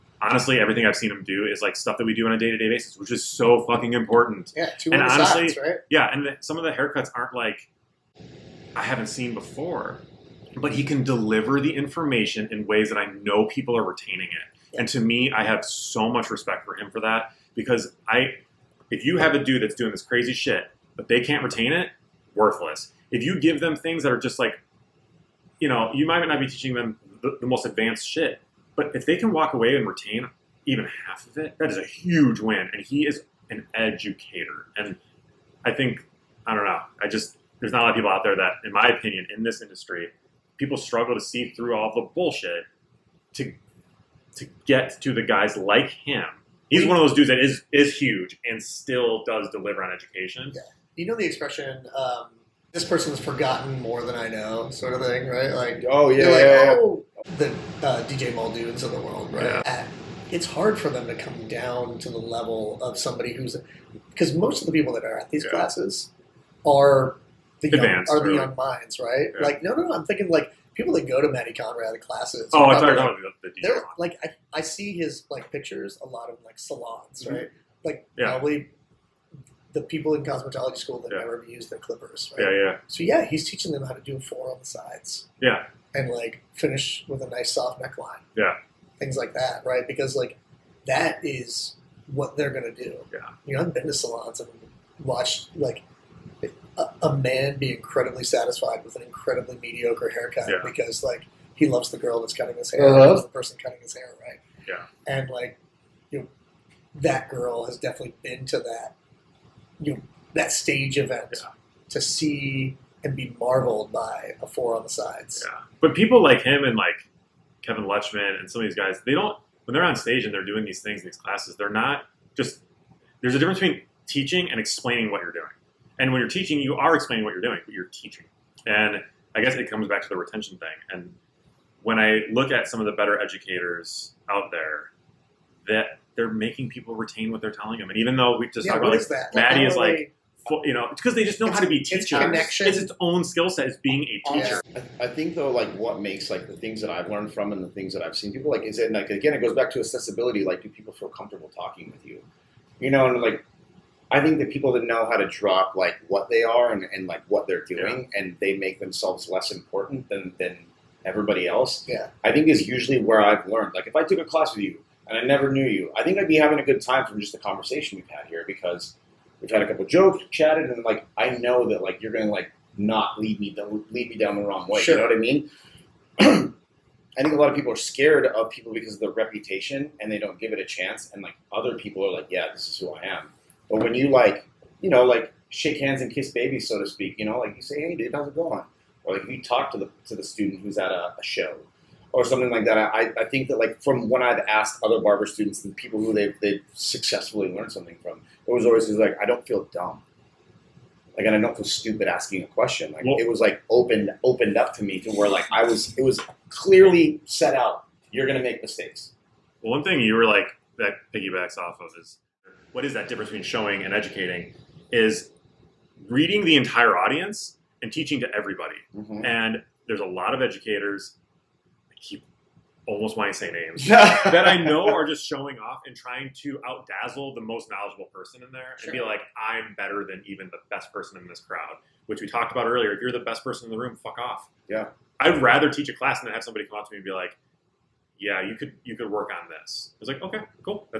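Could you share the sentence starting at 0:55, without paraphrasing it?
Like, oh yeah, like, yeah, oh, the uh, DJ Muldoons of the world, right?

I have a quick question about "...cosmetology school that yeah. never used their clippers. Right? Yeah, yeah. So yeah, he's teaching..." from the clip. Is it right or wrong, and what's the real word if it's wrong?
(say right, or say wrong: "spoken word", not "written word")
right.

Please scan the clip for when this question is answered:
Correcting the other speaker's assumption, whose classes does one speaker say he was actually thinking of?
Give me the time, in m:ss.
1:11.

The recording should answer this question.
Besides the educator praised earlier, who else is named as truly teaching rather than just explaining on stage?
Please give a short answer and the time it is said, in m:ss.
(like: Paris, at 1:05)
Kevin Luchmun, at 1:57.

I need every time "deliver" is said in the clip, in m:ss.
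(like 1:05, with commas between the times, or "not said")
0:11, 0:49.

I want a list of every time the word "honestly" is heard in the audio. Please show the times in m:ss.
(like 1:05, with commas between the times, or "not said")
0:00, 0:05.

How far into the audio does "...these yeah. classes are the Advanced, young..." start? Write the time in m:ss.
1:05.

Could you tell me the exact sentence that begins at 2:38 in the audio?
and they make themselves less important than than everybody else.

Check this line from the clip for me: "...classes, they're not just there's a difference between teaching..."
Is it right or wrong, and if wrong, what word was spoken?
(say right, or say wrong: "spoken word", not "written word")
right.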